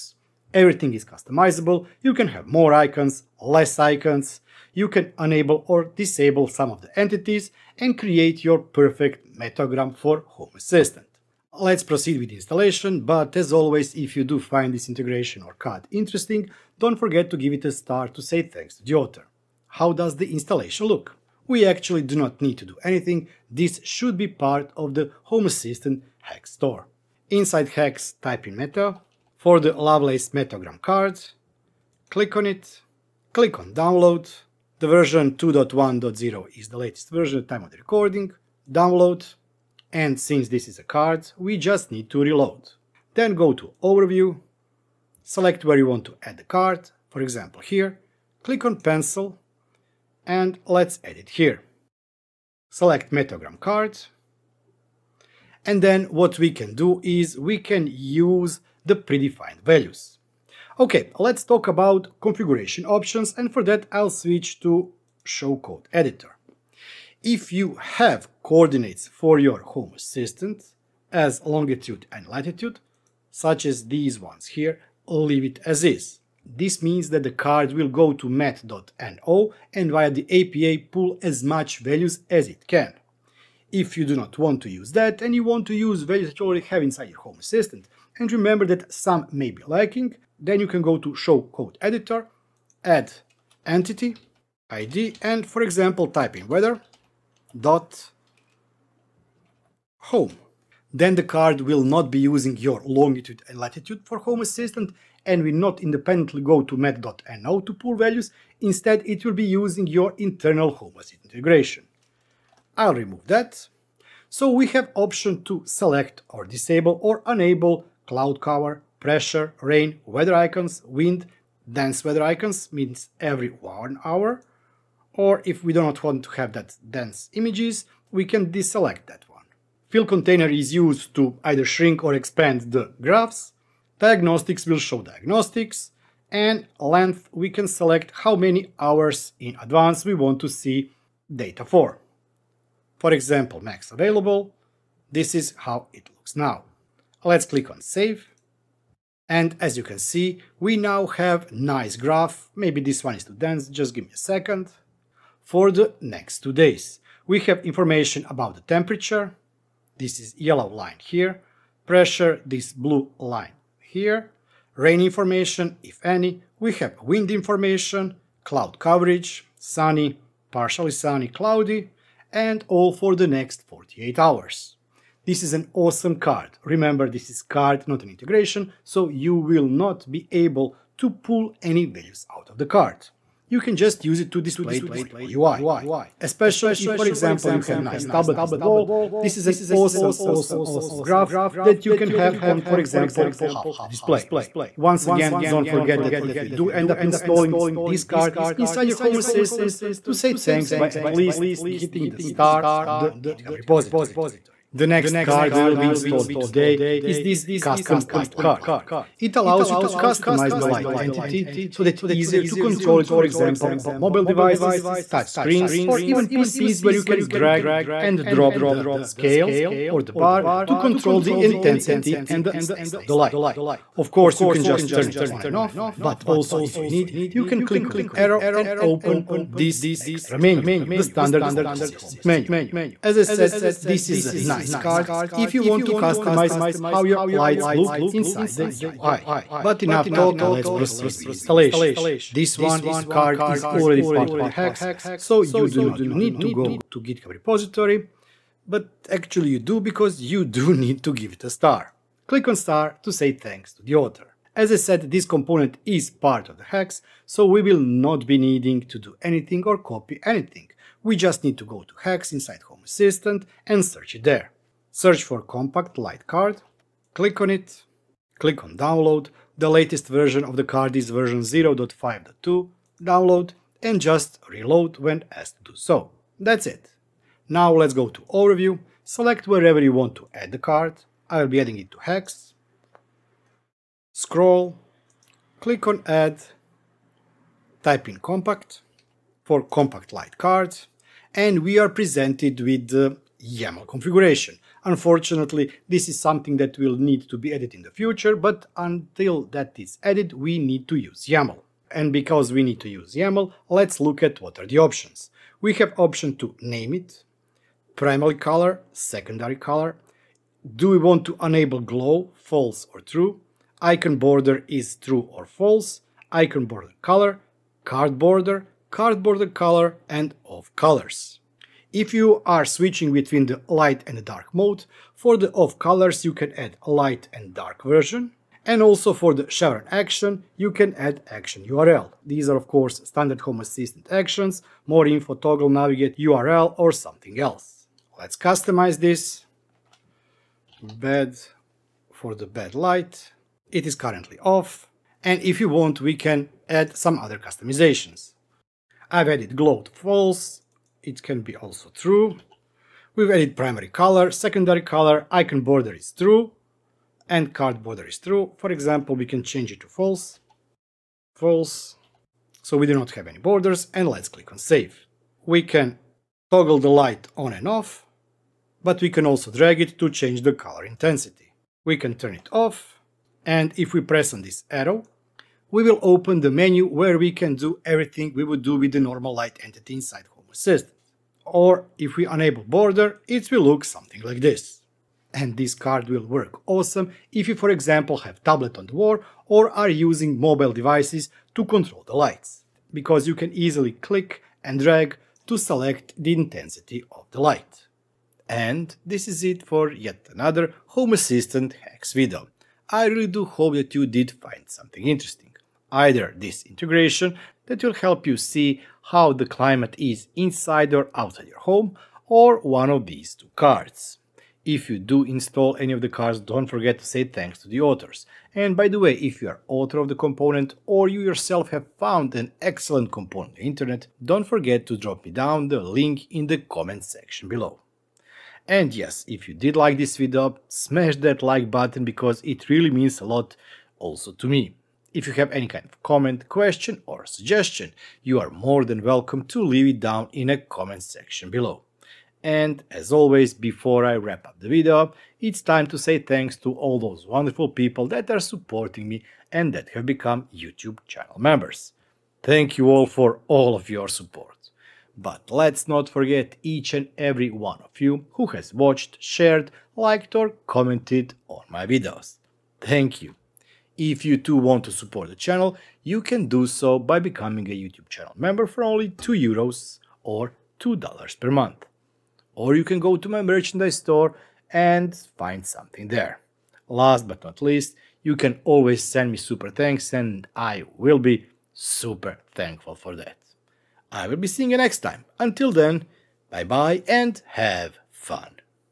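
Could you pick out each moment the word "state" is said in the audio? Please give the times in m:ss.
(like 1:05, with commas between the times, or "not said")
3:42.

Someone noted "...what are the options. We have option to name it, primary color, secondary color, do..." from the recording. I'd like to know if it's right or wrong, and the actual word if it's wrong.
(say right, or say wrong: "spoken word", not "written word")
right.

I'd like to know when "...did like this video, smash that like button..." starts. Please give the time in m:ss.
7:09.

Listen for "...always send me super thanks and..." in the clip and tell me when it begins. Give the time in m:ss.
7:58.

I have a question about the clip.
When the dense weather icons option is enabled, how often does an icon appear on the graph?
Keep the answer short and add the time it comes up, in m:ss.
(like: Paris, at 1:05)
every one hour, at 2:03.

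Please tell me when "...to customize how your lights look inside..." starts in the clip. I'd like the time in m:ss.
3:55.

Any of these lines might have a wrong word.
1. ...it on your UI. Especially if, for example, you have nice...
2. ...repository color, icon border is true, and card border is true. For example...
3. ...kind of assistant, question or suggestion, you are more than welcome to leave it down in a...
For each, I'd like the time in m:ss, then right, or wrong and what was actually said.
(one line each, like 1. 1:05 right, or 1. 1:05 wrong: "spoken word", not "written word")
1. 3:04 right
2. 5:54 wrong: "secondary", not "repository"
3. 7:15 wrong: "comment", not "assistant".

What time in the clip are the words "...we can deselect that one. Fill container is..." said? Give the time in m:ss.
2:08.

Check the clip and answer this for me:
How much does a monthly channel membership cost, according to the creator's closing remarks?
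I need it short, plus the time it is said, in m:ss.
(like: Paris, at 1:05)
2 euros, at 7:49.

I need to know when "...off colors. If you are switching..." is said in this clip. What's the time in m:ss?
5:20.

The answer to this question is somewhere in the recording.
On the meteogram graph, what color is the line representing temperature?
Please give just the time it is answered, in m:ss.
2:40.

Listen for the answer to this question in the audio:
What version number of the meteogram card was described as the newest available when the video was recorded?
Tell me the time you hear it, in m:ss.
0:35.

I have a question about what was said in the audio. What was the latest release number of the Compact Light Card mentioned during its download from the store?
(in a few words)
0.5.2.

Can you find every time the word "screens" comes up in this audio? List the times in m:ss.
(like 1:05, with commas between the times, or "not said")
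3:35.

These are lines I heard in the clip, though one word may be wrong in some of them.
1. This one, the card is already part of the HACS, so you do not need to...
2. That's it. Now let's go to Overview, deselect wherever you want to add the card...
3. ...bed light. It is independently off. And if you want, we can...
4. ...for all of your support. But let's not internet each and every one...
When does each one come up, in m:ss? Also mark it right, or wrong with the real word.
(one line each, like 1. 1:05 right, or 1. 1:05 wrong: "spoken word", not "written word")
1. 4:02 right
2. 4:36 wrong: "select", not "deselect"
3. 5:42 wrong: "currently", not "independently"
4. 7:33 wrong: "forget", not "internet".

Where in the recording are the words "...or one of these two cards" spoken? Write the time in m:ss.
6:52.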